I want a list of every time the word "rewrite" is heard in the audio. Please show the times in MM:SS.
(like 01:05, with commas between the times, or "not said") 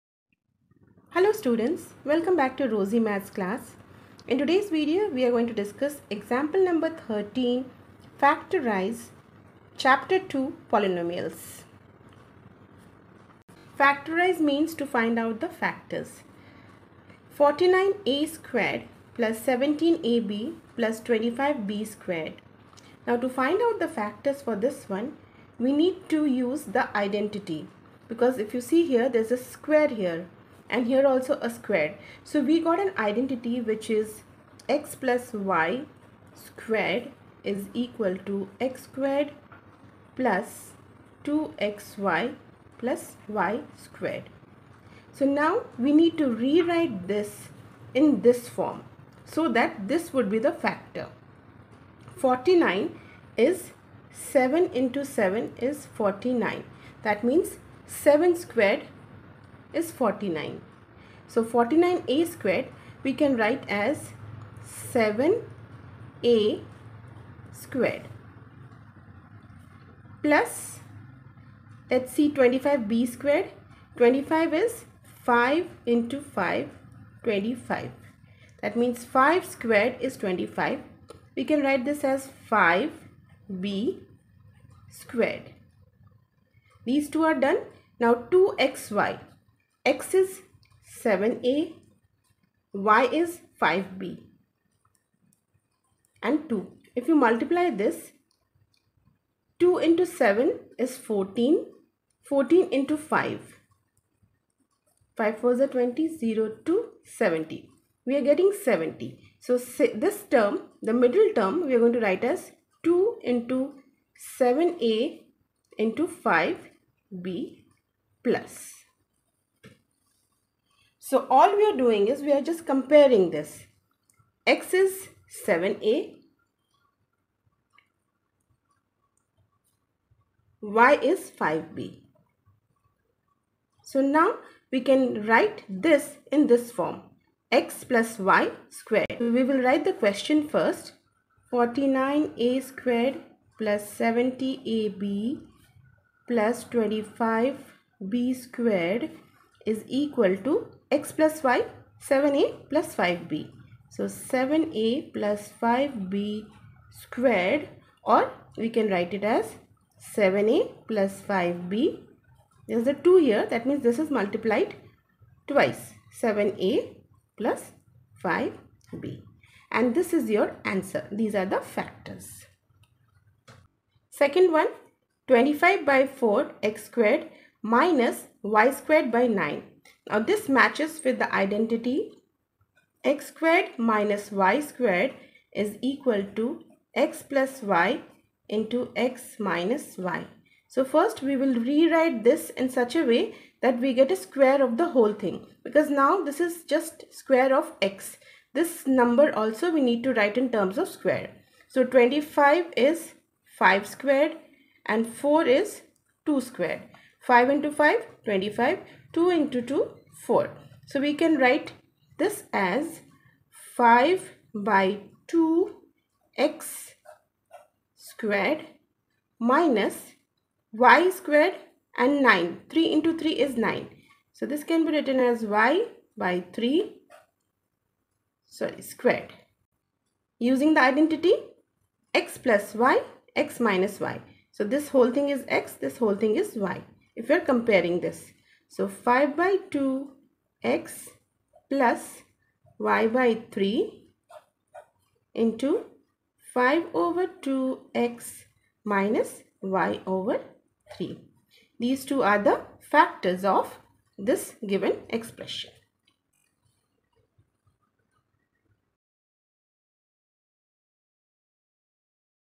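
00:46, 03:11.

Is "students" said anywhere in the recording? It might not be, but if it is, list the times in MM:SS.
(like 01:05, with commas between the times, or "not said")
00:01.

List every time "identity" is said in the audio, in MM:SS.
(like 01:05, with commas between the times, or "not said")
00:26, 00:32, 03:01, 03:50.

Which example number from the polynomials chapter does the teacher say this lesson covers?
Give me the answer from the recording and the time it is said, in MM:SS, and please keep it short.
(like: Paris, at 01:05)
13, at 00:06.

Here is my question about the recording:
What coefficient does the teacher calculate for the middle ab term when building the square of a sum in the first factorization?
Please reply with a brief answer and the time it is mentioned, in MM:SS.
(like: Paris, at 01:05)
70, at 01:48.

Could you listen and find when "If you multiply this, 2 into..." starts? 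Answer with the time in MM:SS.
01:36.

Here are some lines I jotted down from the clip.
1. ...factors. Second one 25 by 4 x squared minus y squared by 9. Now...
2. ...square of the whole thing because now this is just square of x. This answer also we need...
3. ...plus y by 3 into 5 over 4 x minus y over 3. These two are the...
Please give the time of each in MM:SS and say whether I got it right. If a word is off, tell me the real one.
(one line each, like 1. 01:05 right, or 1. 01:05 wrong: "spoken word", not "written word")
1. 02:51 right
2. 03:14 wrong: "number", not "answer"
3. 04:01 wrong: "2", not "4".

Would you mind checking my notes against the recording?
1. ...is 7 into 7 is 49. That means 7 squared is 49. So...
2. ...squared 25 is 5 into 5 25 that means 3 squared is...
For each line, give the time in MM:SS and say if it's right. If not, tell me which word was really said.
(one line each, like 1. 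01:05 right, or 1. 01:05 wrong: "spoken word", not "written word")
1. 00:53 right
2. 01:13 wrong: "5", not "3".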